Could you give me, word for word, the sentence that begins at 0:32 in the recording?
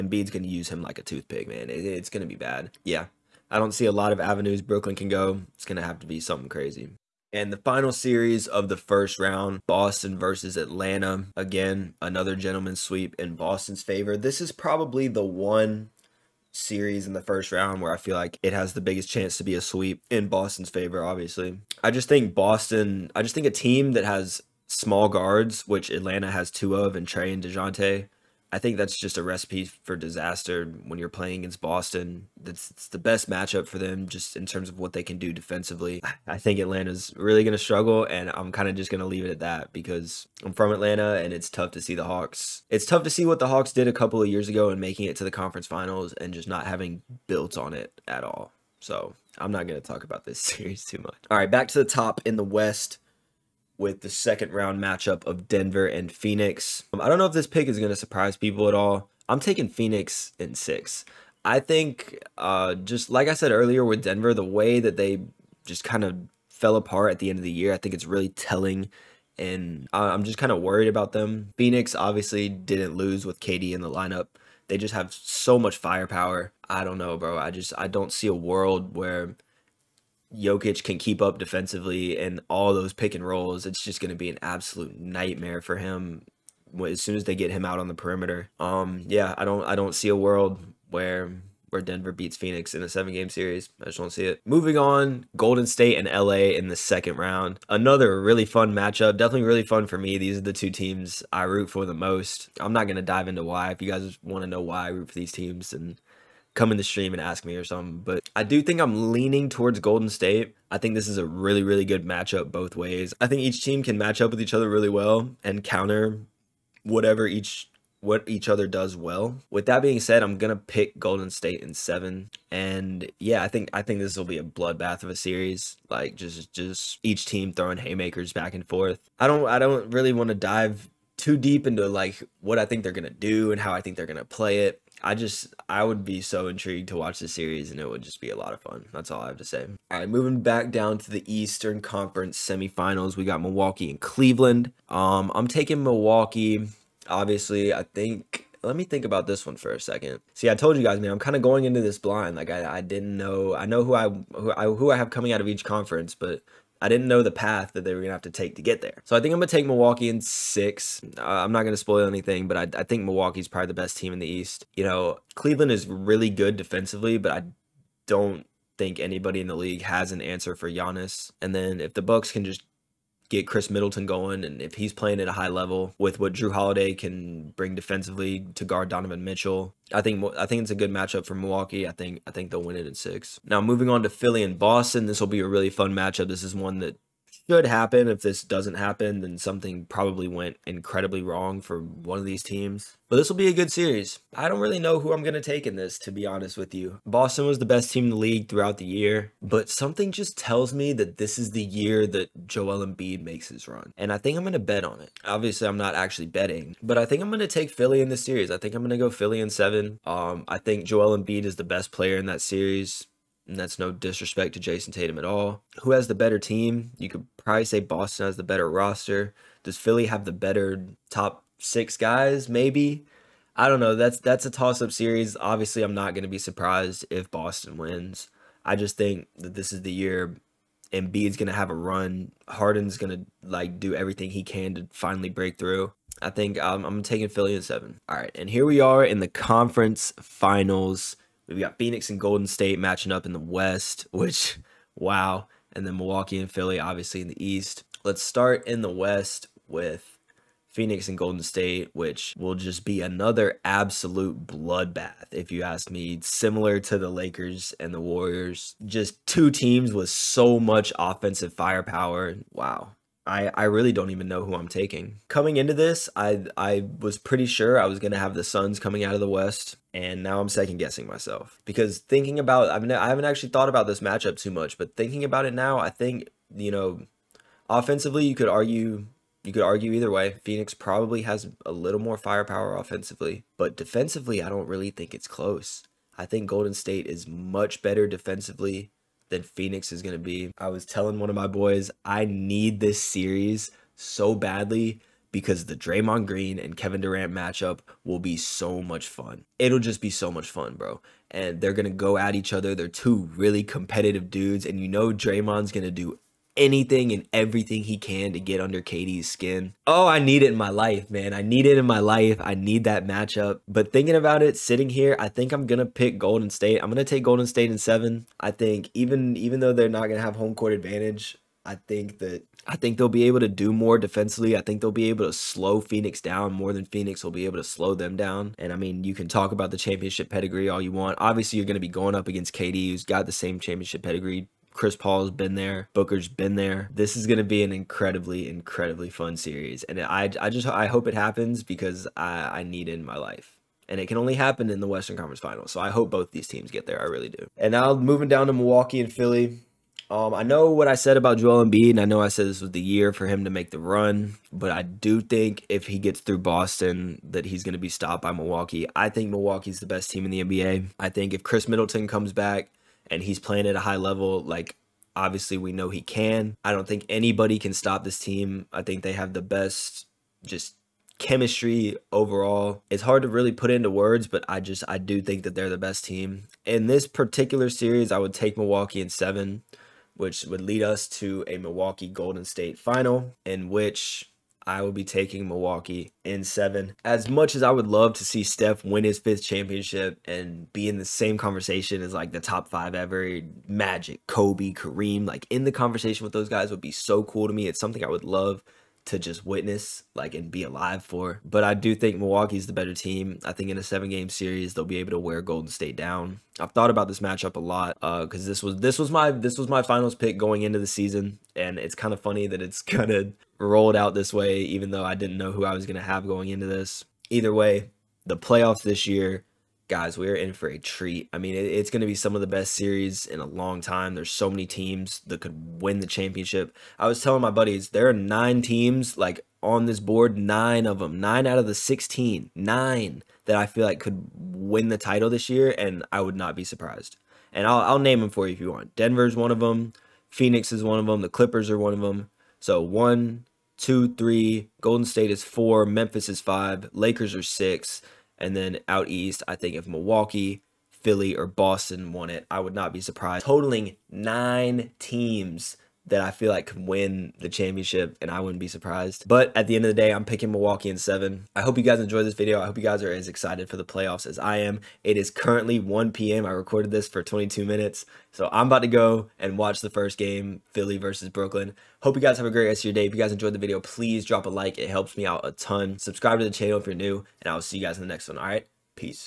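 That's it's the best matchup for them just in terms of what they can do defensively.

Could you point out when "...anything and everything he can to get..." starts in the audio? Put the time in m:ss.
5:06.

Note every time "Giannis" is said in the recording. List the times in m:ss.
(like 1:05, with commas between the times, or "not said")
2:50.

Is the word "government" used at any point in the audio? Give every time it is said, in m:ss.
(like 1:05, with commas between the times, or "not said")
not said.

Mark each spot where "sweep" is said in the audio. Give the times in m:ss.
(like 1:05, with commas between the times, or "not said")
0:12, 0:19.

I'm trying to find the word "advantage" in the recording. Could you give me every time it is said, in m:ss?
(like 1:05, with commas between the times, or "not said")
5:20.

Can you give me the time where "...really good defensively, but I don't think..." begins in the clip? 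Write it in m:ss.
2:45.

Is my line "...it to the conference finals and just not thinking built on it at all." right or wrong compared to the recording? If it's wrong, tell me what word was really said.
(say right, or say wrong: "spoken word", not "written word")
wrong: "having", not "thinking".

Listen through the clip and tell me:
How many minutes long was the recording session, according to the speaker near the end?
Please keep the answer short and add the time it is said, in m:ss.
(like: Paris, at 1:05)
22, at 7:47.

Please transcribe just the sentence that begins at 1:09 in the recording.
And I'm just kind of worried about them.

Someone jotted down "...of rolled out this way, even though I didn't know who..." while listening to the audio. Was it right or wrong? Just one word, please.
right.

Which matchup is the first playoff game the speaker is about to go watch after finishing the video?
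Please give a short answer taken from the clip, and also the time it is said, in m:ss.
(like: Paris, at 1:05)
Philly versus Brooklyn, at 7:50.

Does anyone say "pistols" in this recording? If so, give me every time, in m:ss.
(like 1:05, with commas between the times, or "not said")
not said.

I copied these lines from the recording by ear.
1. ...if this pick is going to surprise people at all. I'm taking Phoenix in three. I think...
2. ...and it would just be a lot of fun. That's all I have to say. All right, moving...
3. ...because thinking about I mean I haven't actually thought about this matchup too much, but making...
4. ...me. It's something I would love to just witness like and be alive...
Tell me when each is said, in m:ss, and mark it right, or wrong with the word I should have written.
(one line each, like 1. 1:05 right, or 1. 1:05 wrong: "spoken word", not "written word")
1. 0:57 wrong: "six", not "three"
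2. 2:17 right
3. 4:31 wrong: "thinking", not "making"
4. 6:37 right.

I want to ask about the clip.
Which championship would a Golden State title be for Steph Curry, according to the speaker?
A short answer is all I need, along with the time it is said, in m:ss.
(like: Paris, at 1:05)
fifth, at 6:29.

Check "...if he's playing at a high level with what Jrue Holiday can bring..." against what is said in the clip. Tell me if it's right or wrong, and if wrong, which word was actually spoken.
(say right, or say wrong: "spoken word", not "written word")
right.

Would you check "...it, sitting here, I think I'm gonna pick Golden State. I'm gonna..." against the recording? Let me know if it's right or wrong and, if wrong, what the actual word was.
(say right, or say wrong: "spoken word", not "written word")
right.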